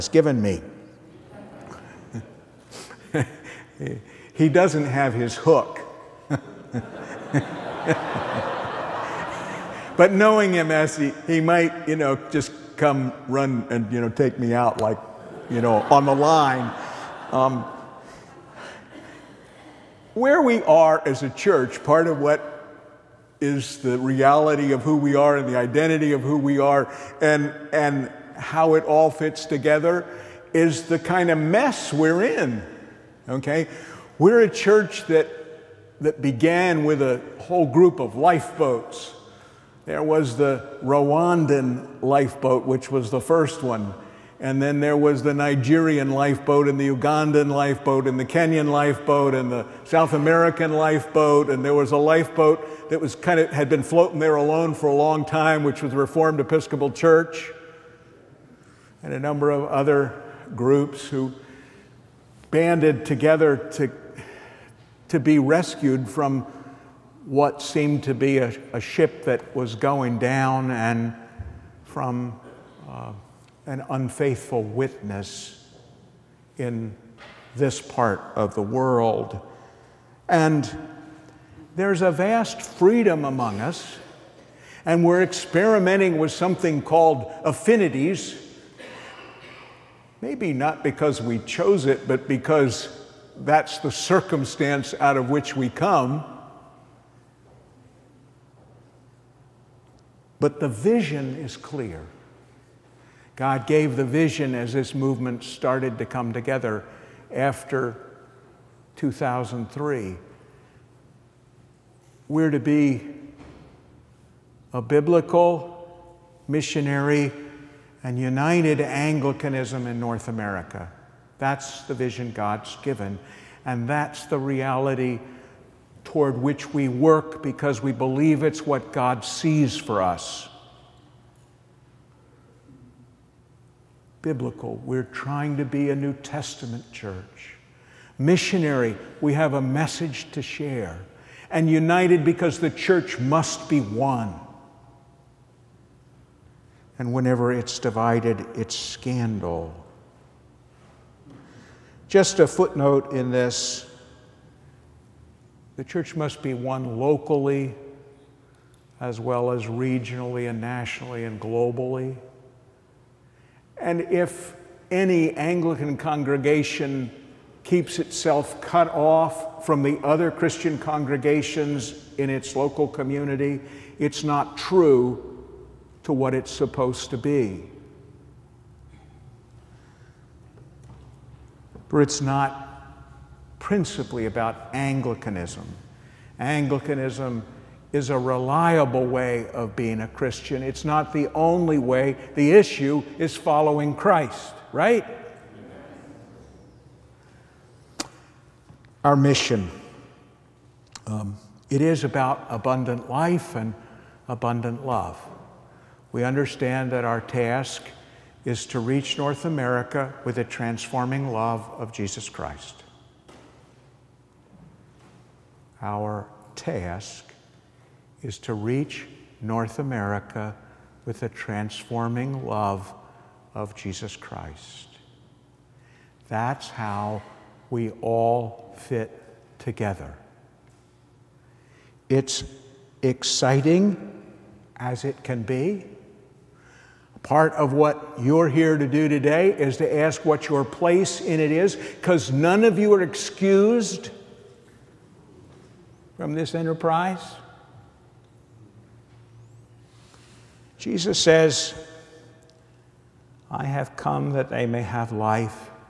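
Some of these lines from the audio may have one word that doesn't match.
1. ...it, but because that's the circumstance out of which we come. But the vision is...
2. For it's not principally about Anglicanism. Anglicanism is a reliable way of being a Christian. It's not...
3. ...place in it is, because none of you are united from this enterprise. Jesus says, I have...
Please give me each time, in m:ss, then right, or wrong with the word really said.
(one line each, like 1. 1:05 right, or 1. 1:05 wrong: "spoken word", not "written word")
1. 1:31 right
2. 3:01 right
3. 4:00 wrong: "excused", not "united".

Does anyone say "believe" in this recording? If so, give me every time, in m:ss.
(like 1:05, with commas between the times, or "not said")
2:07.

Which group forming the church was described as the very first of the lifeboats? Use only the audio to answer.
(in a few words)
Rwandan.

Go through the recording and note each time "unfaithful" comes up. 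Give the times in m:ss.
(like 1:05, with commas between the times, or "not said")
1:13.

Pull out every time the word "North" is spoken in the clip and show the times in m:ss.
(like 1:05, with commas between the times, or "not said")
2:00, 3:29, 3:39.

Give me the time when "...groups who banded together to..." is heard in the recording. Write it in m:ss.
1:00.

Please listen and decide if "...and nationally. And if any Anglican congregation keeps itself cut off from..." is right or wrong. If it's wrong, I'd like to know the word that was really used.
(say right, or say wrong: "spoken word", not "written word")
wrong: "globally", not "nationally".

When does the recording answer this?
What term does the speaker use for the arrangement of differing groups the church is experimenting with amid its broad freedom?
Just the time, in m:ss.
1:27.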